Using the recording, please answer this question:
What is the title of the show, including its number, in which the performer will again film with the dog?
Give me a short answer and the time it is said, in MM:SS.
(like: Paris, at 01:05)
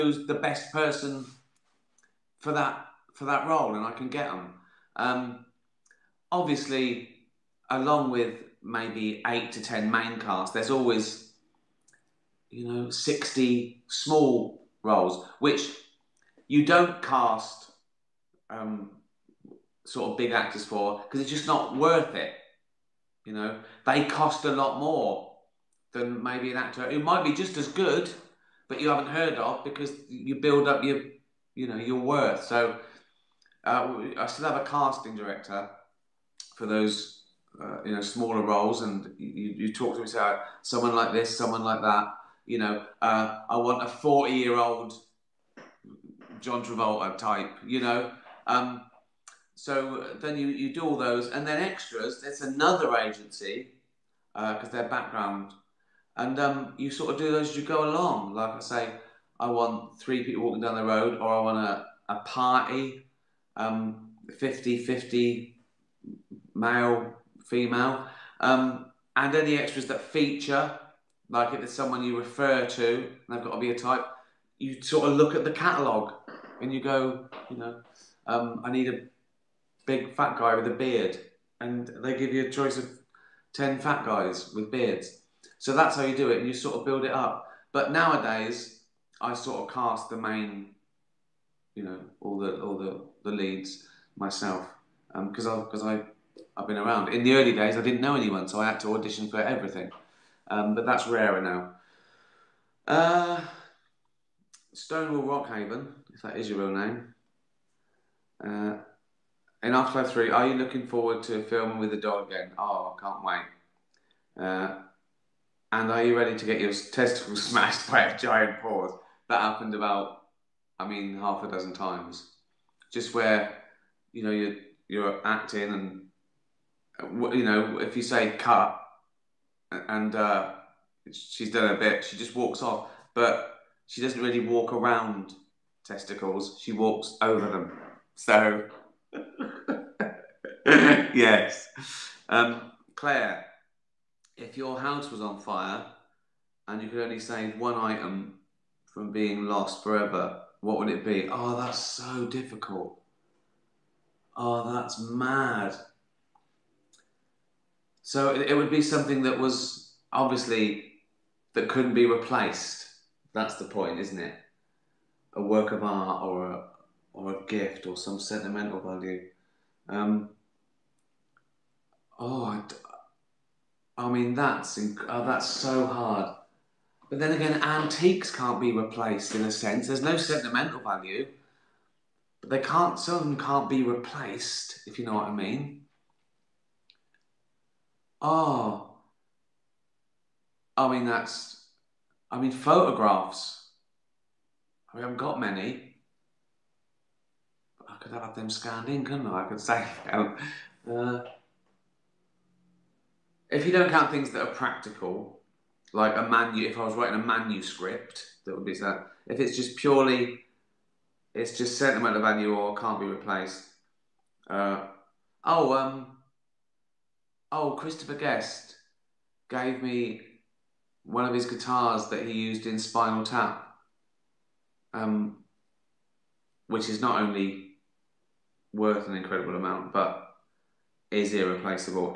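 Afterlife 3, at 01:49.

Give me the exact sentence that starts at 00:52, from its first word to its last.
There's another agency because uh, are background, and um, you sort of do those as you go along.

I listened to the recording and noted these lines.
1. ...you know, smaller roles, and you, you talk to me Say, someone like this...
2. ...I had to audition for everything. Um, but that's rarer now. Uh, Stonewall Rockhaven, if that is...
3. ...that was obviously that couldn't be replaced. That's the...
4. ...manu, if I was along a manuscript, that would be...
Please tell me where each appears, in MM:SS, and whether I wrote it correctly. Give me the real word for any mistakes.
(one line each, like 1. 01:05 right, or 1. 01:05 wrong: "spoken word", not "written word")
1. 00:37 right
2. 01:38 right
3. 02:39 right
4. 03:26 wrong: "writing", not "along".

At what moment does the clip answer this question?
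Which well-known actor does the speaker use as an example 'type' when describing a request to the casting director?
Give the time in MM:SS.
00:46.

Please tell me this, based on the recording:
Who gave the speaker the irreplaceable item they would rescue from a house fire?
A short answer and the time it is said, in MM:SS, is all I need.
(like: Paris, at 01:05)
Christopher Guest, at 03:37.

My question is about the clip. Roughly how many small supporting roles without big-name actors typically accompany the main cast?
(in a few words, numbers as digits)
60.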